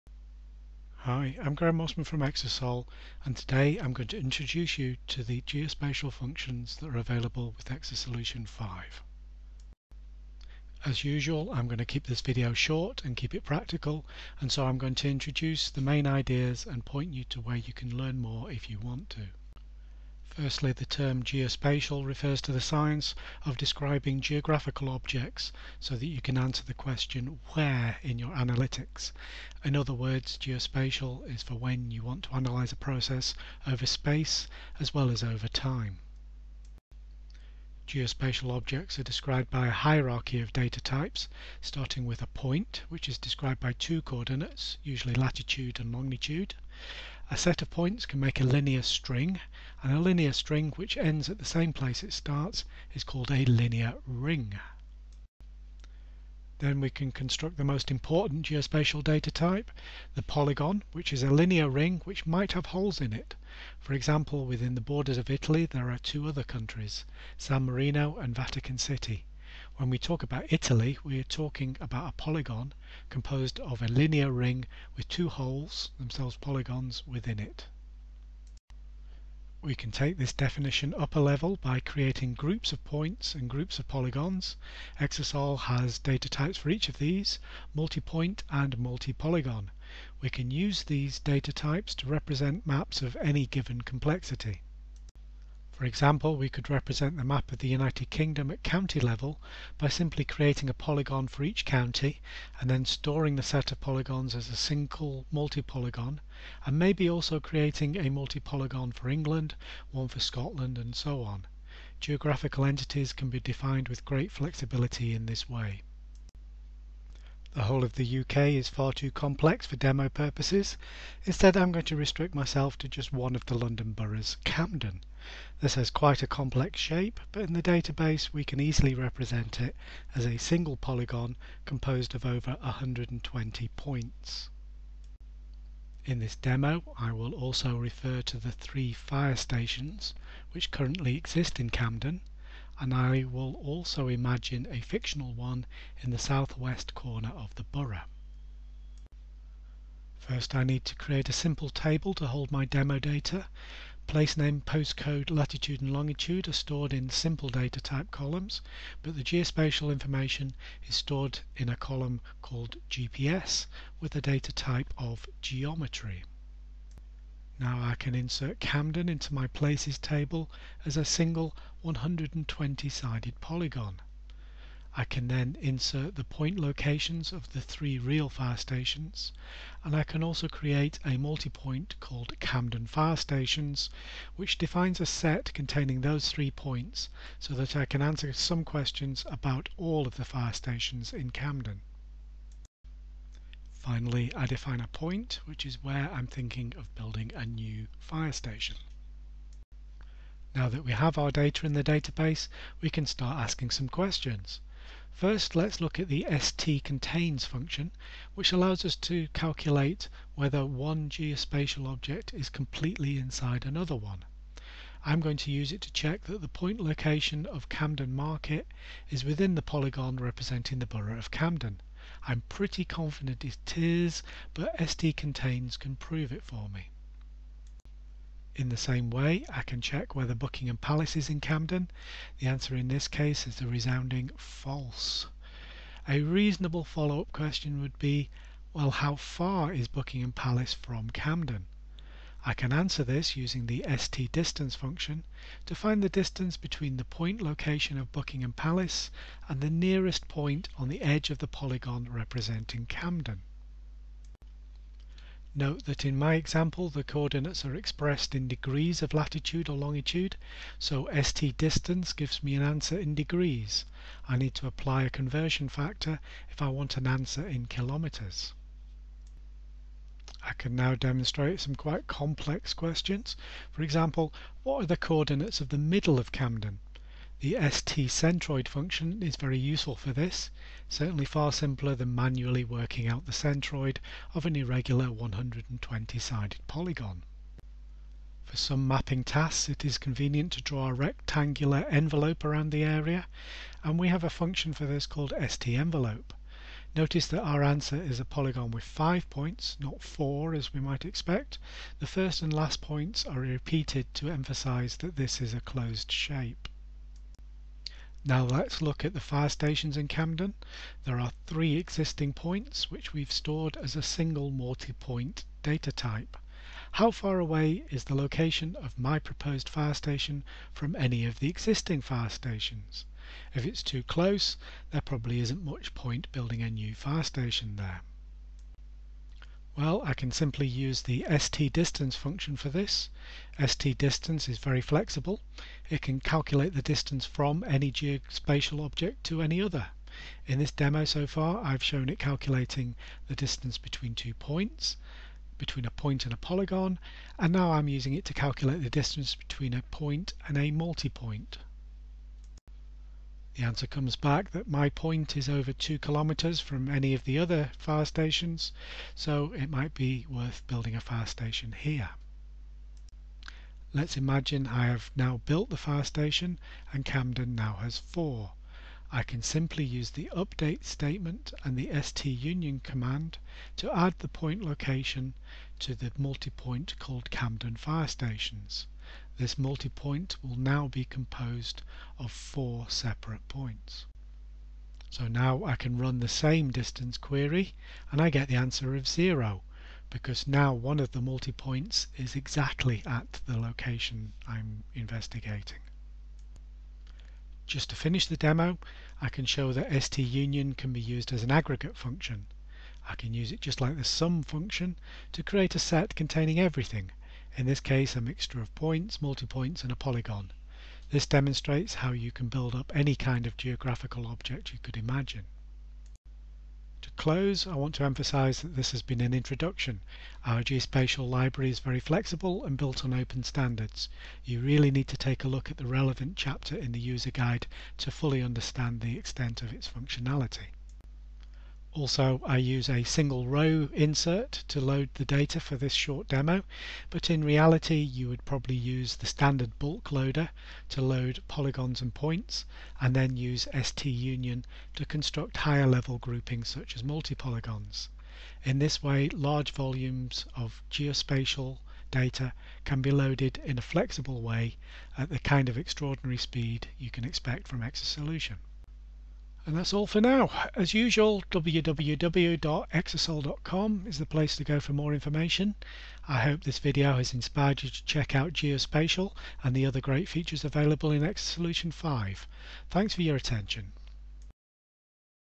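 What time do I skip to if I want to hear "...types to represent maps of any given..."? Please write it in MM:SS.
01:31.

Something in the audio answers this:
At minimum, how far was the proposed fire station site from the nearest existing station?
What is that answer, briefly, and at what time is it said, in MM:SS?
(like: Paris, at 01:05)
over 2 kilometers, at 05:55.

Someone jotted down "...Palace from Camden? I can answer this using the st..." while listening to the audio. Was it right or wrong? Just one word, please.
right.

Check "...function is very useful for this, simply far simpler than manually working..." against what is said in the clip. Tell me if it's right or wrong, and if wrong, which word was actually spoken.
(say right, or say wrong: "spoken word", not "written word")
wrong: "certainly", not "simply".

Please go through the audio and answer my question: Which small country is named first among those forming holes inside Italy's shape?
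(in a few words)
San Marino.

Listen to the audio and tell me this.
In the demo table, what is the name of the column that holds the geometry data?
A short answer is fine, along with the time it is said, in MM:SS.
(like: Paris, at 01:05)
GPS, at 02:42.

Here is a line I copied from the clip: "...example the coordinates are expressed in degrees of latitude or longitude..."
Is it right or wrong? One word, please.
right.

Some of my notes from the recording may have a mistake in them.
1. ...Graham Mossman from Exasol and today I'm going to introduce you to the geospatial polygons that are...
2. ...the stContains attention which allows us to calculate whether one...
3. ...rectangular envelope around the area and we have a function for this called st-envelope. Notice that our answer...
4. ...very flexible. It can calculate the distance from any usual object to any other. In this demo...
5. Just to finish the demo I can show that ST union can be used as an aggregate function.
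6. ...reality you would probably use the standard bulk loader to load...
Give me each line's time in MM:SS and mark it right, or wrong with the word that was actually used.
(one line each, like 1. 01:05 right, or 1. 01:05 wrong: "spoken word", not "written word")
1. 00:01 wrong: "functions", not "polygons"
2. 03:26 wrong: "function", not "attention"
3. 04:50 right
4. 05:34 wrong: "geospatial", not "usual"
5. 06:37 right
6. 07:17 right.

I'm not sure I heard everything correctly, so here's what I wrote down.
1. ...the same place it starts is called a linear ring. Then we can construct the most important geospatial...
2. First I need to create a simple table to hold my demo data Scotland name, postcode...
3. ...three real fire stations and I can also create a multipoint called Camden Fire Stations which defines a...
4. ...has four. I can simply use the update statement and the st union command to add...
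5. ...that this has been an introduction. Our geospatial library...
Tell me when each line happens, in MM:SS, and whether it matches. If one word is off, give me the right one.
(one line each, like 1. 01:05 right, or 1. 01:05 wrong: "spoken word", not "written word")
1. 00:51 right
2. 02:30 wrong: "Place", not "Scotland"
3. 02:57 right
4. 06:07 right
5. 06:58 right.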